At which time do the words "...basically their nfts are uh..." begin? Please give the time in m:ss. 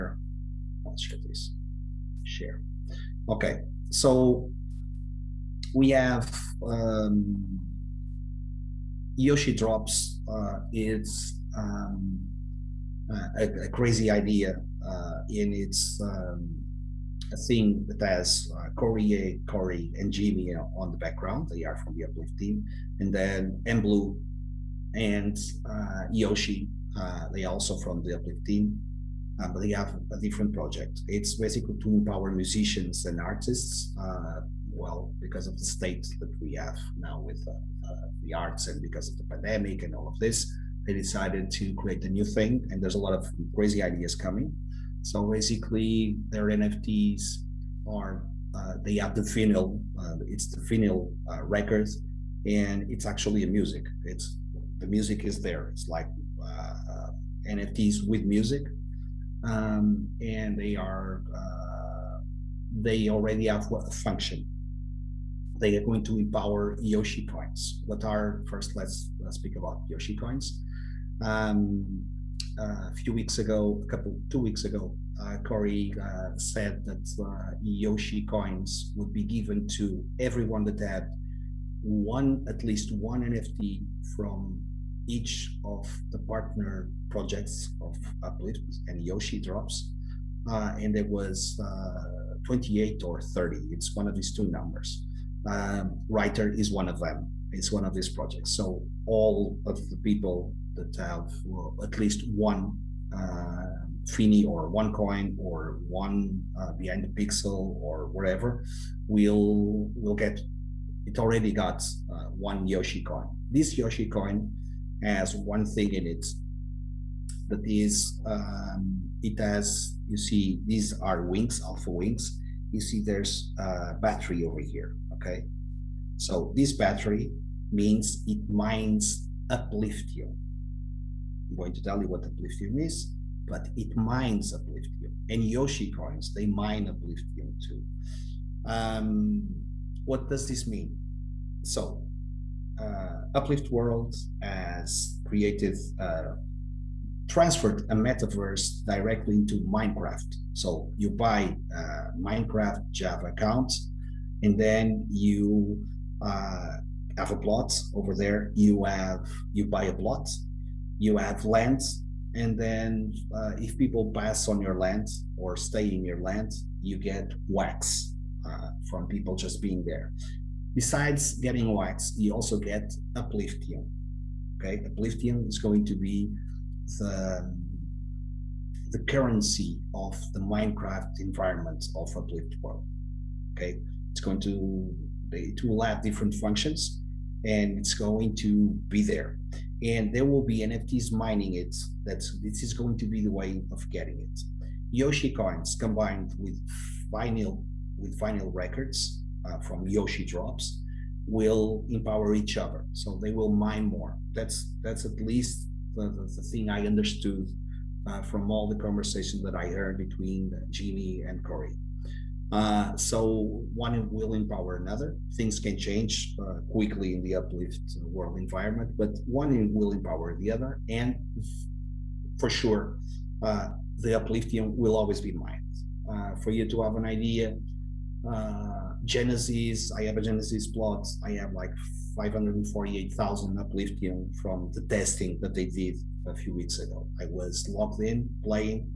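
0:45.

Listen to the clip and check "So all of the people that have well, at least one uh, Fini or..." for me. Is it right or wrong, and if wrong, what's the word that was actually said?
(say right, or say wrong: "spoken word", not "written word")
right.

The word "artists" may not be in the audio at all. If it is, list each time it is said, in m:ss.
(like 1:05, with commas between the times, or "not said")
0:33.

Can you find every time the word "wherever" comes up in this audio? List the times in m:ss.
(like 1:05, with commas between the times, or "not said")
not said.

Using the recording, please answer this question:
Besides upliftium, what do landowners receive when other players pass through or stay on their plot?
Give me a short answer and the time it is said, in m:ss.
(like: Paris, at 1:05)
wax, at 2:47.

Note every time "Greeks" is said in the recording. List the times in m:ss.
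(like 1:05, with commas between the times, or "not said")
not said.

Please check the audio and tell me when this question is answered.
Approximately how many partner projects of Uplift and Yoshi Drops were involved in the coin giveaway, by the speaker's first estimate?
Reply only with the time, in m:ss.
1:32.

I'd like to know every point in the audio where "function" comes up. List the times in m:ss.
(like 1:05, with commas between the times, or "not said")
1:03, 3:06.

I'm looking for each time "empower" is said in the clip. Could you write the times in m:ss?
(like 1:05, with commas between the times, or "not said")
0:31, 1:06, 3:21, 3:34, 3:39.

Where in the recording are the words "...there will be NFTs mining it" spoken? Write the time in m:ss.
3:10.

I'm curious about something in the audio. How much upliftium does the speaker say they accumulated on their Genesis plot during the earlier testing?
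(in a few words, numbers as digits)
548,000.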